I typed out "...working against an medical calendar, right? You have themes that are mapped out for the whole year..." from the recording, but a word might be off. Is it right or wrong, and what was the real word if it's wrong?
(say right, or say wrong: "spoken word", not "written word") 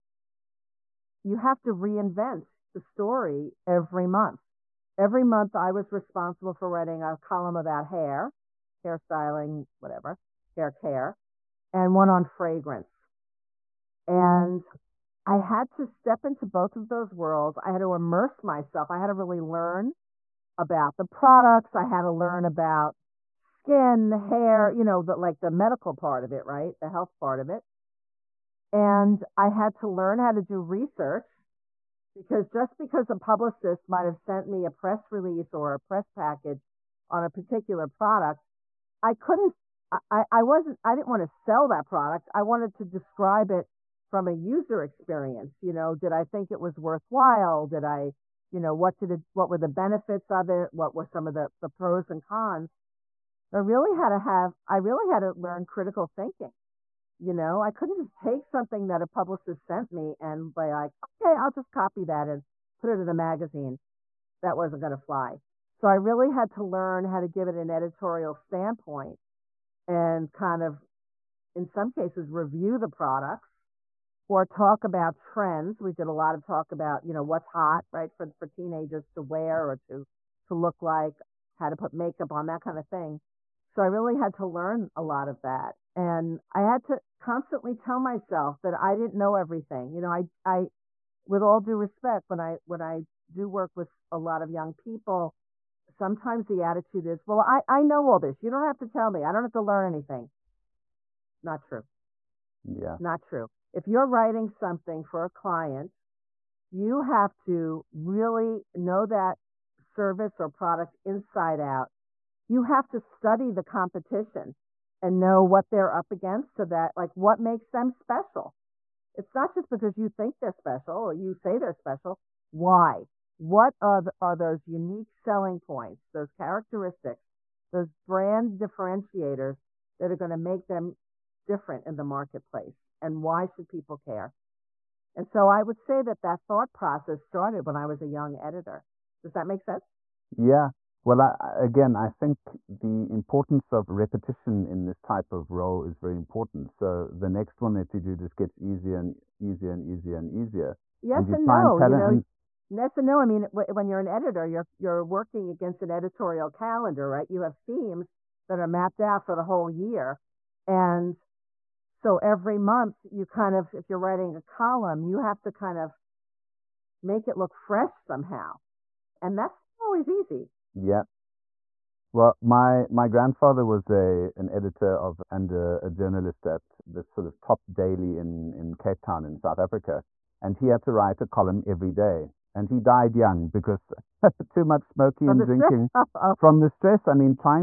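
wrong: "editorial", not "medical".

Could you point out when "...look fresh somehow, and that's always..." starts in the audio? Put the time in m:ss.
2:47.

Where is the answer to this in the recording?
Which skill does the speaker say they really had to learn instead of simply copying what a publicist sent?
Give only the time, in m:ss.
0:55.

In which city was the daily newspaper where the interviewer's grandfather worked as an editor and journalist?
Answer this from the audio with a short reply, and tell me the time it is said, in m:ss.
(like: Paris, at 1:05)
Cape Town, at 2:58.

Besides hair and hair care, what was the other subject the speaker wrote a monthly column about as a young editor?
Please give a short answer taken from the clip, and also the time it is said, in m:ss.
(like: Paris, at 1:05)
Fragrance, at 0:12.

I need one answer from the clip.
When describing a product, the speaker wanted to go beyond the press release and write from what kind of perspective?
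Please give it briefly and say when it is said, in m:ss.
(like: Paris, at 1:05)
User experience, at 0:44.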